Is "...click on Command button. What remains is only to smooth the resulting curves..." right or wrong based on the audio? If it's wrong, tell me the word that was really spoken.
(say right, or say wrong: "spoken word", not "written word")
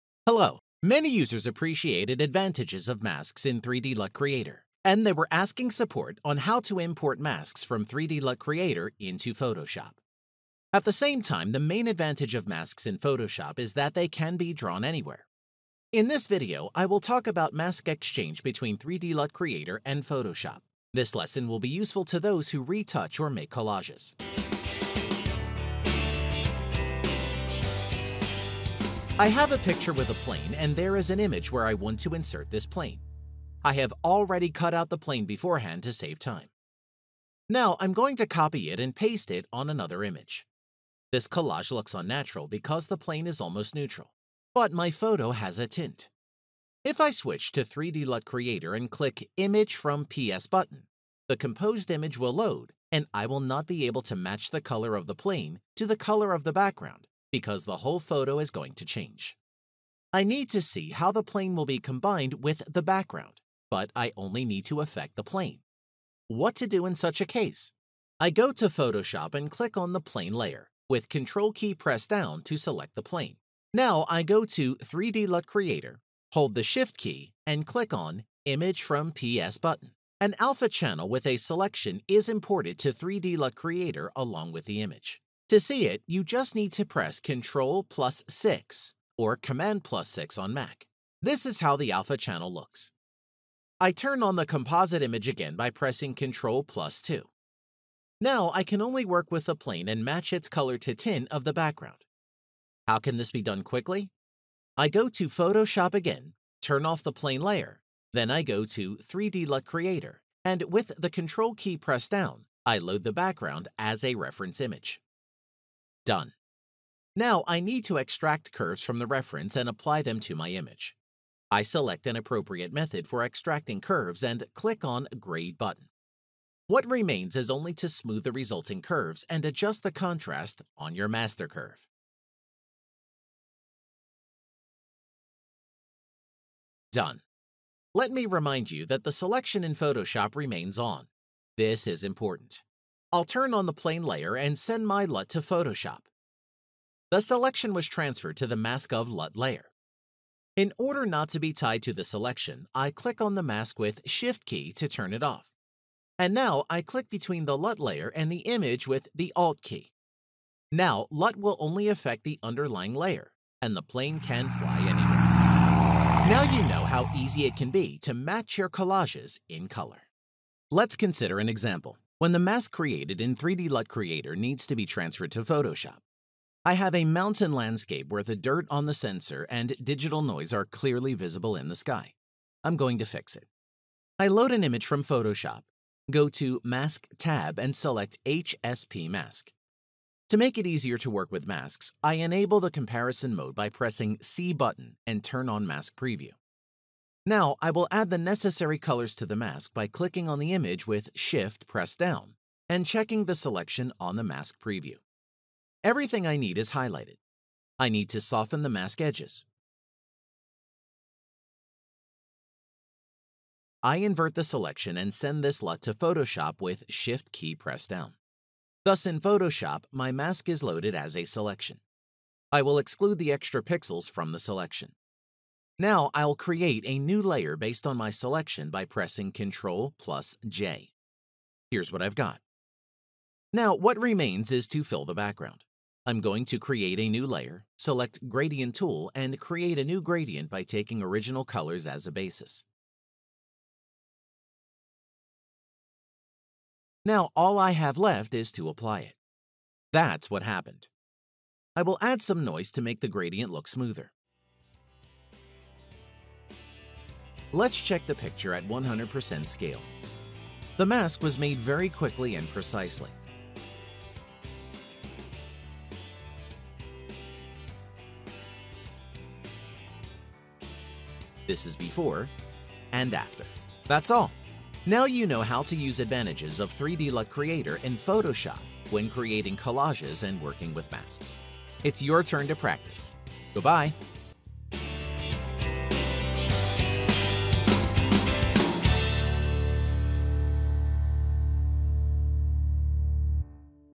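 wrong: "Grade", not "Command".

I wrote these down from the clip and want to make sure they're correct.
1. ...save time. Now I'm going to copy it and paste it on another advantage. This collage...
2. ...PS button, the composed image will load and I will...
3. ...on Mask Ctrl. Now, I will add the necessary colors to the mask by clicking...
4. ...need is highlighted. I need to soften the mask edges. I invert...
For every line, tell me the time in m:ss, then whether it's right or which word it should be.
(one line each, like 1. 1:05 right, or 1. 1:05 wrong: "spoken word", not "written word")
1. 0:35 wrong: "image", not "advantage"
2. 0:50 right
3. 3:15 wrong: "Preview", not "Ctrl"
4. 3:26 right.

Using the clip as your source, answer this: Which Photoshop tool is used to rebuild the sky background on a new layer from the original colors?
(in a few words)
Gradient Tool.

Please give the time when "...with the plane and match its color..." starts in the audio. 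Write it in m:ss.
1:39.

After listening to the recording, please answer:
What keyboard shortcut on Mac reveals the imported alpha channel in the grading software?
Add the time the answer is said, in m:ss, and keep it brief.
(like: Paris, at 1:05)
Command+6, at 1:29.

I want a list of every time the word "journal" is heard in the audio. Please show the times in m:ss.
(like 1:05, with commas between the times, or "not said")
not said.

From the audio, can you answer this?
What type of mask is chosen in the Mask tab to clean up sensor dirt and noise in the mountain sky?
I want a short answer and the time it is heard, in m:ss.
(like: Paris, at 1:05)
HSP Mask, at 3:08.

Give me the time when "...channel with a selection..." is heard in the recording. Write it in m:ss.
1:20.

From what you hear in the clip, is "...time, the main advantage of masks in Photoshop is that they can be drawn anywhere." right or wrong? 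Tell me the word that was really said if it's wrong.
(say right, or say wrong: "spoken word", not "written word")
right.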